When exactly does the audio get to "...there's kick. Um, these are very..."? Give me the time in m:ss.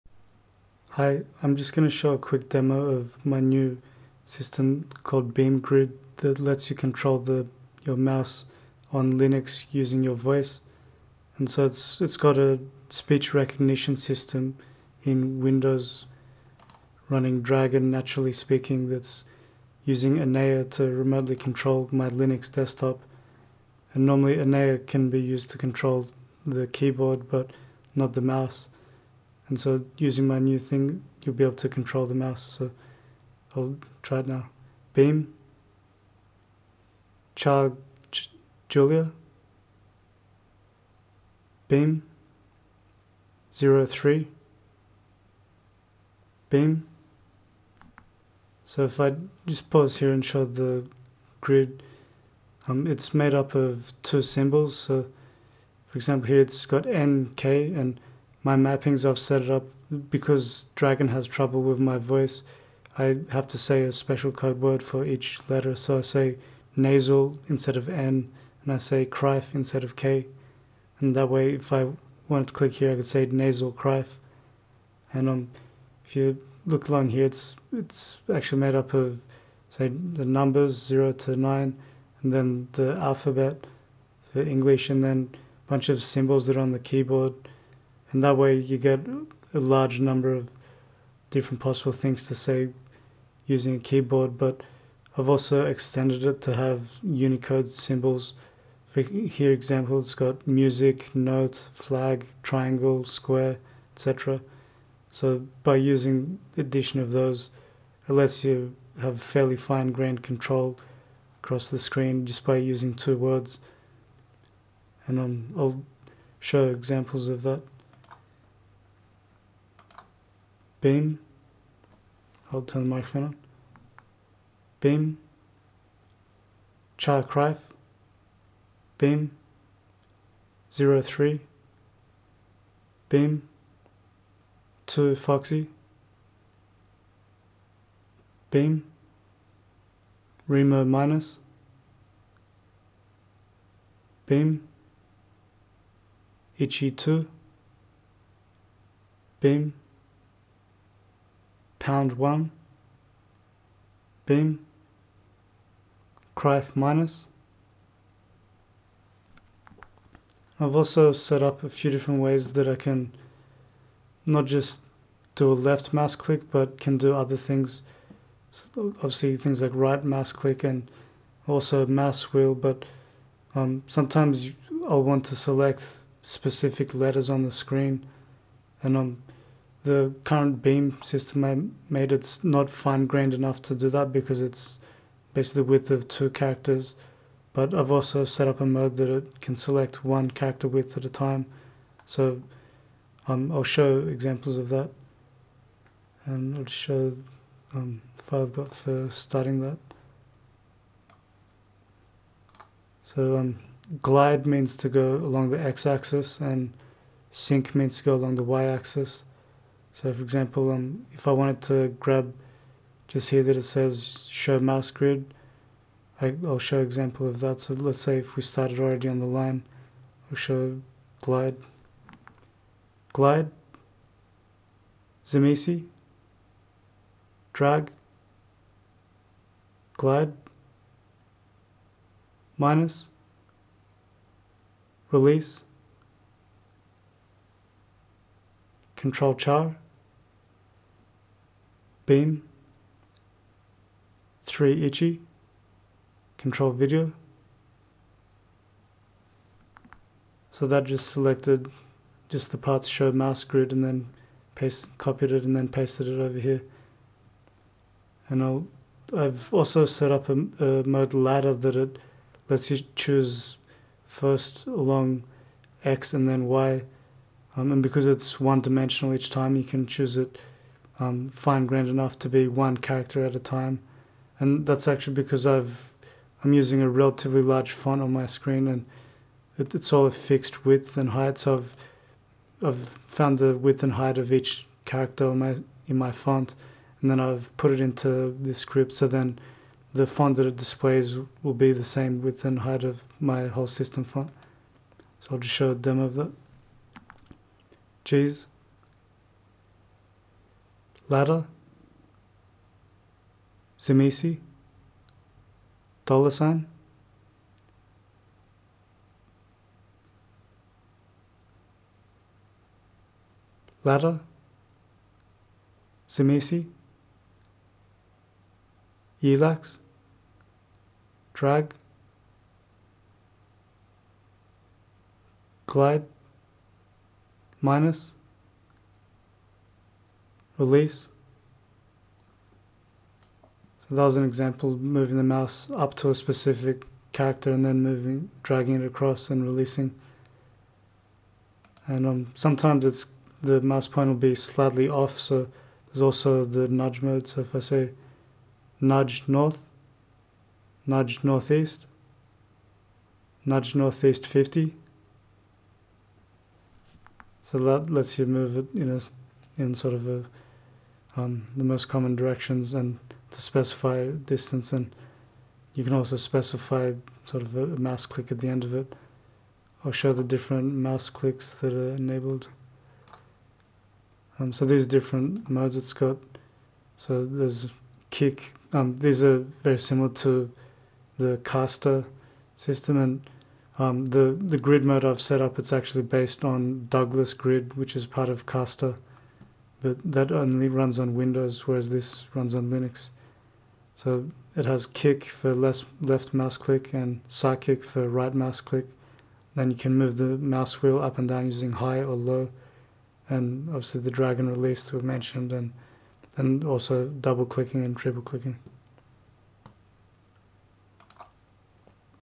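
6:17.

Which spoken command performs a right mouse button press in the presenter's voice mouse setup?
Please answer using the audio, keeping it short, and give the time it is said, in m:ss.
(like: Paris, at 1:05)
sidekick, at 6:37.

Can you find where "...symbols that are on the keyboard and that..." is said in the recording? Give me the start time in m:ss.
1:26.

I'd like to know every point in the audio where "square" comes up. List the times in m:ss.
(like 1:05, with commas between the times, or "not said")
1:43.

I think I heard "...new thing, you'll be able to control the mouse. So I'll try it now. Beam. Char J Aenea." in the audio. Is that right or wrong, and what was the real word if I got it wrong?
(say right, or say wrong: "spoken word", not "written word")
wrong: "Julia", not "Aenea".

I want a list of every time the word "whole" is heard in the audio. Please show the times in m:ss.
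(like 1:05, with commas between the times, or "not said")
4:53.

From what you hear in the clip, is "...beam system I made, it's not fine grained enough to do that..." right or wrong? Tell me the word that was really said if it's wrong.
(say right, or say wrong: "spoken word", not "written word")
right.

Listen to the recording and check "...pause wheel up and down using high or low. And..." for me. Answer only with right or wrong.
wrong.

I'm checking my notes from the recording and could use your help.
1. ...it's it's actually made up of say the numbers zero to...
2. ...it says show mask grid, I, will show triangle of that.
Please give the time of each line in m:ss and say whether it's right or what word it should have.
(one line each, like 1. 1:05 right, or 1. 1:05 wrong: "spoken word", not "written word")
1. 1:17 right
2. 3:33 wrong: "example", not "triangle".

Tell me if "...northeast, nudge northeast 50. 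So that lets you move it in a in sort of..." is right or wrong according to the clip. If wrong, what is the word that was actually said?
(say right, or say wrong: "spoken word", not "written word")
right.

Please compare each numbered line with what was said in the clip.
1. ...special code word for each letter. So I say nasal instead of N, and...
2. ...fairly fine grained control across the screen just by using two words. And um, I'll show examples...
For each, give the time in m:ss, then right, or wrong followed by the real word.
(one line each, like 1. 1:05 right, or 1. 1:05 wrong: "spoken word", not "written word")
1. 1:03 right
2. 1:49 right.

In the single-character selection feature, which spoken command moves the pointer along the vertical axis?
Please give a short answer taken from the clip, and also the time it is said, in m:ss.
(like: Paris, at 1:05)
sync, at 3:27.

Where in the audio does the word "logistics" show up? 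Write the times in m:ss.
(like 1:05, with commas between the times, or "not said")
not said.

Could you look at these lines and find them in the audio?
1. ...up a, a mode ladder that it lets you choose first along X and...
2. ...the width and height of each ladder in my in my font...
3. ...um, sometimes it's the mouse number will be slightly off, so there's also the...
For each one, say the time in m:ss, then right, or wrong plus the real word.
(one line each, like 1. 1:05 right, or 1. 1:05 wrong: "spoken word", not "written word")
1. 4:20 right
2. 4:43 wrong: "character", not "ladder"
3. 5:42 wrong: "pointer", not "number".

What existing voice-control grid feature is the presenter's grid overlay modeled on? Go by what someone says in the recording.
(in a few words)
Douglas grid.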